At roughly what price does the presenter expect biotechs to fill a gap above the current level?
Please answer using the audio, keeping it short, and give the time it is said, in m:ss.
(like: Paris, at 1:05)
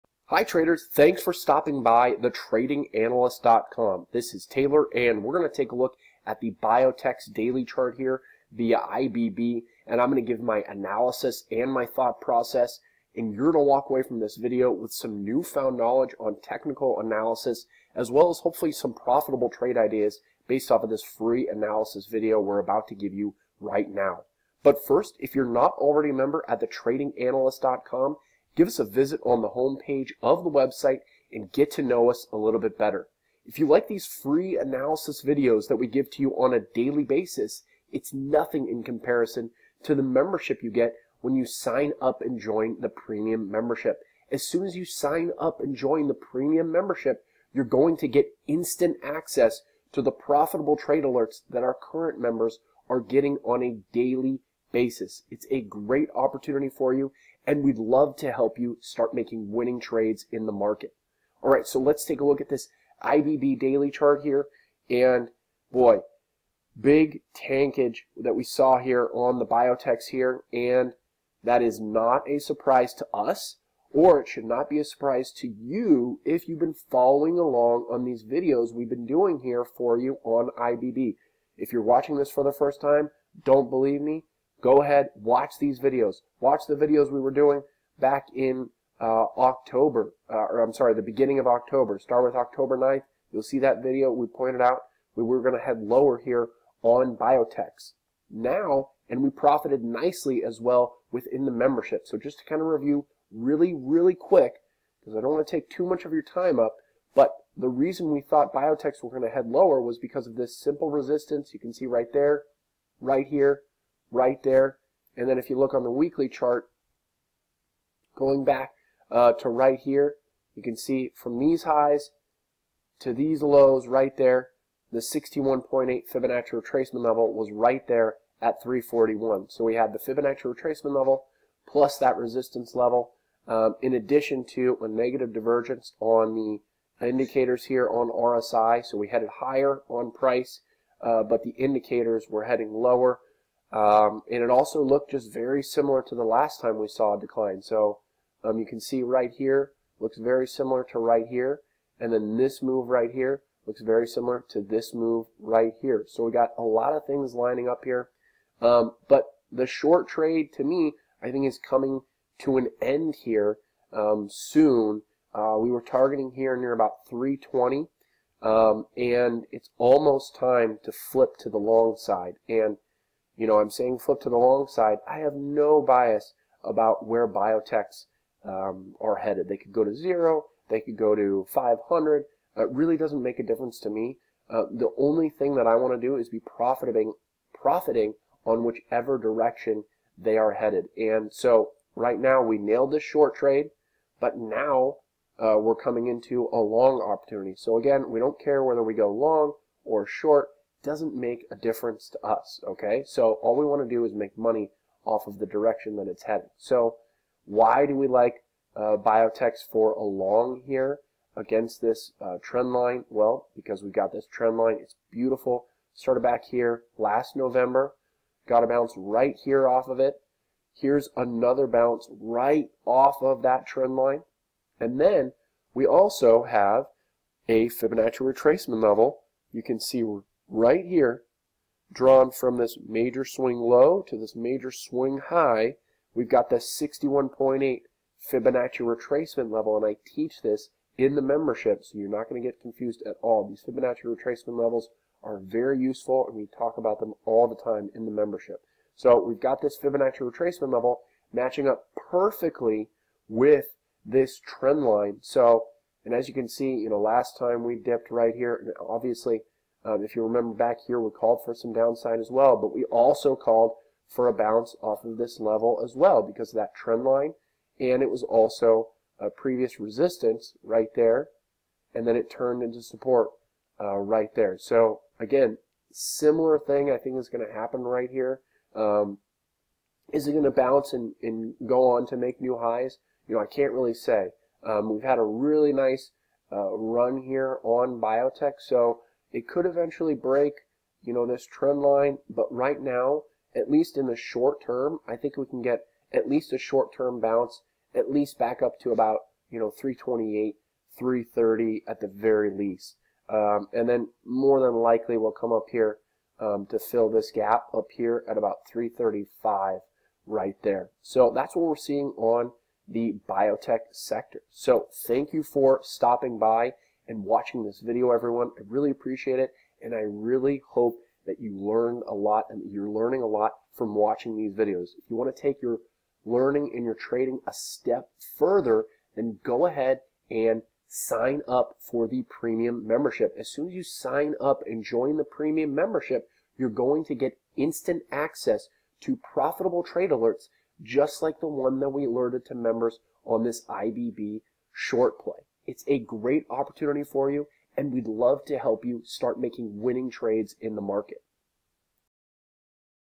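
335, at 5:08.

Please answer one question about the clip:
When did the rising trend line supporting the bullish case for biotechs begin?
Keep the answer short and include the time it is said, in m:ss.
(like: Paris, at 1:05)
last November, at 3:36.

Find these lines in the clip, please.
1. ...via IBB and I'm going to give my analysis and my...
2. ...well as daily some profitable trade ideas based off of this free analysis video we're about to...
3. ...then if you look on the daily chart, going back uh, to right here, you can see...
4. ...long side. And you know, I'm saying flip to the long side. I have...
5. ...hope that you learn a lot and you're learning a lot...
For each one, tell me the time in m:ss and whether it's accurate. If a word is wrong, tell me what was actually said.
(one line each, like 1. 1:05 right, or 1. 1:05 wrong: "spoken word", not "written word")
1. 0:08 right
2. 0:18 wrong: "hopefully", not "daily"
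3. 1:55 wrong: "weekly", not "daily"
4. 2:51 right
5. 5:20 right.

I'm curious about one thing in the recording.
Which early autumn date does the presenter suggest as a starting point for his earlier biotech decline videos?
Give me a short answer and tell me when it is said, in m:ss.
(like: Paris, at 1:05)
October 9th, at 1:32.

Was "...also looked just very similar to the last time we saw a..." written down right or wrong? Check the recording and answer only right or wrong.
right.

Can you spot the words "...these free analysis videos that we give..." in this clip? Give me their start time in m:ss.
0:33.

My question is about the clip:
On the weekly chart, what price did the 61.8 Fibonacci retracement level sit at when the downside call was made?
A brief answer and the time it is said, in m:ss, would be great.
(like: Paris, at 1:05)
341, at 2:08.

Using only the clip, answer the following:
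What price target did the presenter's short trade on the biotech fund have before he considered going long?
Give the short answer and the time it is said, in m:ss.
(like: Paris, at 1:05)
320, at 2:47.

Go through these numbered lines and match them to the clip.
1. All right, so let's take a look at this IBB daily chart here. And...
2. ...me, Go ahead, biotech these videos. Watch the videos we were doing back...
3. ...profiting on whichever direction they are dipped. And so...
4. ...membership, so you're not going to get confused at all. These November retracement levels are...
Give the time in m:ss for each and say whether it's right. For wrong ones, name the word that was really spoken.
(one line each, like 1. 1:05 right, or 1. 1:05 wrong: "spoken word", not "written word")
1. 1:01 right
2. 1:24 wrong: "watch", not "biotech"
3. 3:07 wrong: "headed", not "dipped"
4. 4:01 wrong: "Fibonacci", not "November".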